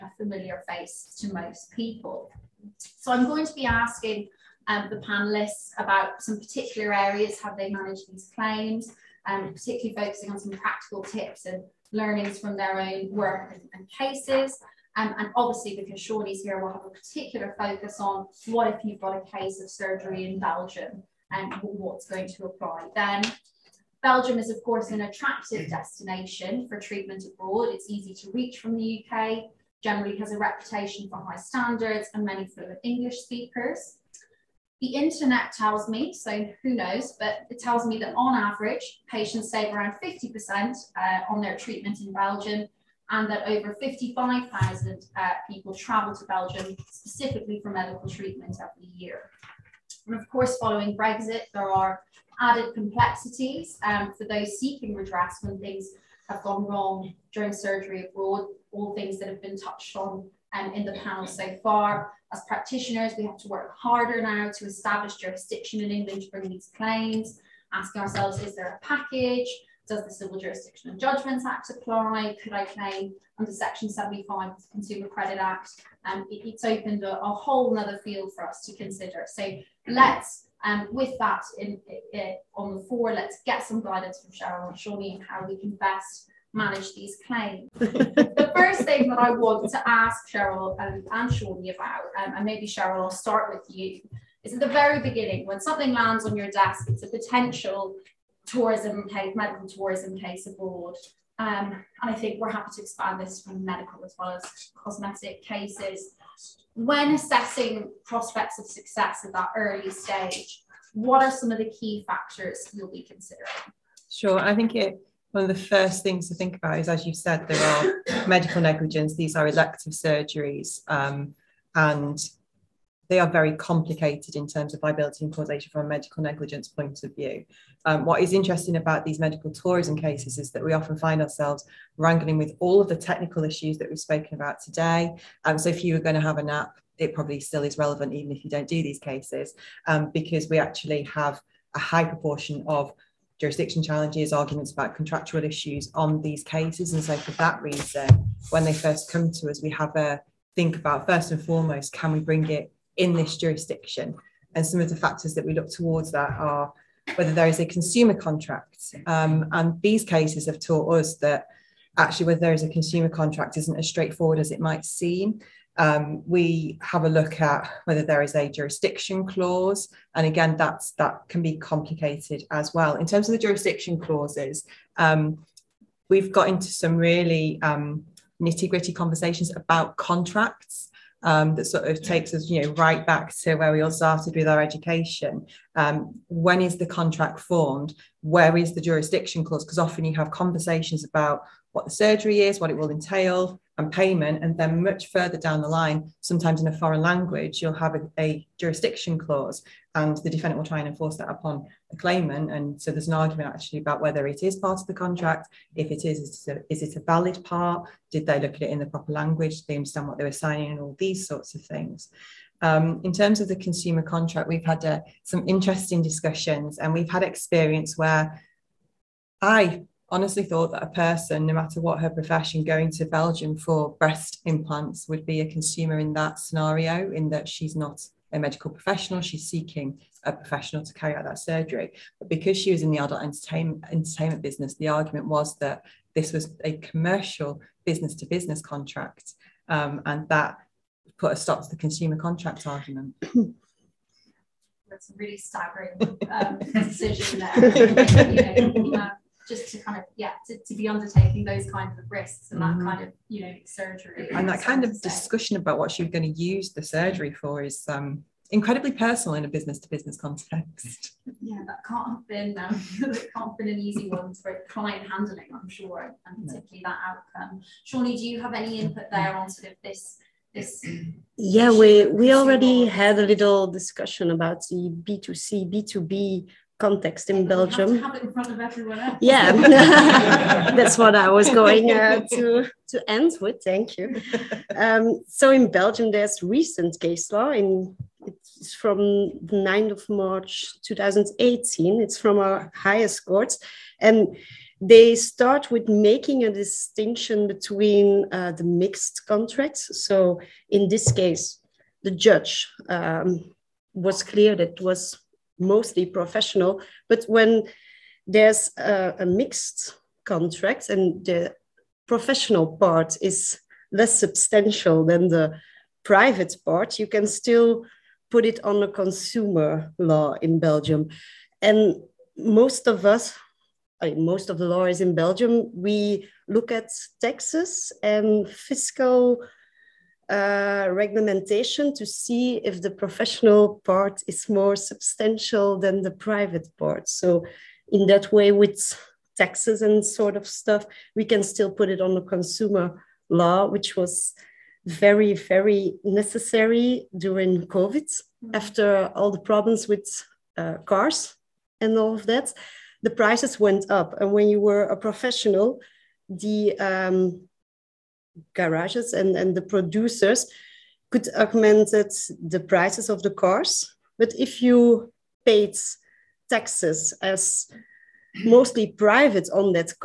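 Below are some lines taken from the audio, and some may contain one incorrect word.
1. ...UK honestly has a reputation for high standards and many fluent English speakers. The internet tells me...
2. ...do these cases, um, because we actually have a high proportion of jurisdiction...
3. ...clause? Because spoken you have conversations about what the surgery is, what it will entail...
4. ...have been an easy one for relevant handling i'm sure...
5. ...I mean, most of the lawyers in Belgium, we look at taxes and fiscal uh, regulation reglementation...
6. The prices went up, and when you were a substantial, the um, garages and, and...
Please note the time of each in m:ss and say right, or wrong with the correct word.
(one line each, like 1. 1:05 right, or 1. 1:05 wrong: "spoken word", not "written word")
1. 0:29 wrong: "generally", not "honestly"
2. 2:18 right
3. 3:09 wrong: "often", not "spoken"
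4. 4:23 wrong: "client", not "relevant"
5. 5:24 right
6. 5:53 wrong: "professional", not "substantial".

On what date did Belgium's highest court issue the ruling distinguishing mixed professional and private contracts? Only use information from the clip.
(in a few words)
9 March 2018.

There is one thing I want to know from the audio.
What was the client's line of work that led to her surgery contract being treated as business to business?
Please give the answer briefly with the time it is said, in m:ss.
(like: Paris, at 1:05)
adult entertainment, at 3:52.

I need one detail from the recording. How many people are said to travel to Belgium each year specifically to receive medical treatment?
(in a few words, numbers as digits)
over 55,000.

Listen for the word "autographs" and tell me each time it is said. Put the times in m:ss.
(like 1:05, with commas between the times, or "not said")
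not said.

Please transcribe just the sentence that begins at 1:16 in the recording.
Um, it, it's opened a, a whole other field for us to consider.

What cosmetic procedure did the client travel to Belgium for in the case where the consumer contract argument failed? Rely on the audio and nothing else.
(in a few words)
breast implants.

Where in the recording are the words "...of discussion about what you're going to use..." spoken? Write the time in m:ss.
4:14.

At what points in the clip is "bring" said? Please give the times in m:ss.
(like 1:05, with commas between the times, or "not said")
1:06, 2:32.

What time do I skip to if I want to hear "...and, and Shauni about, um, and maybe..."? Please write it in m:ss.
1:30.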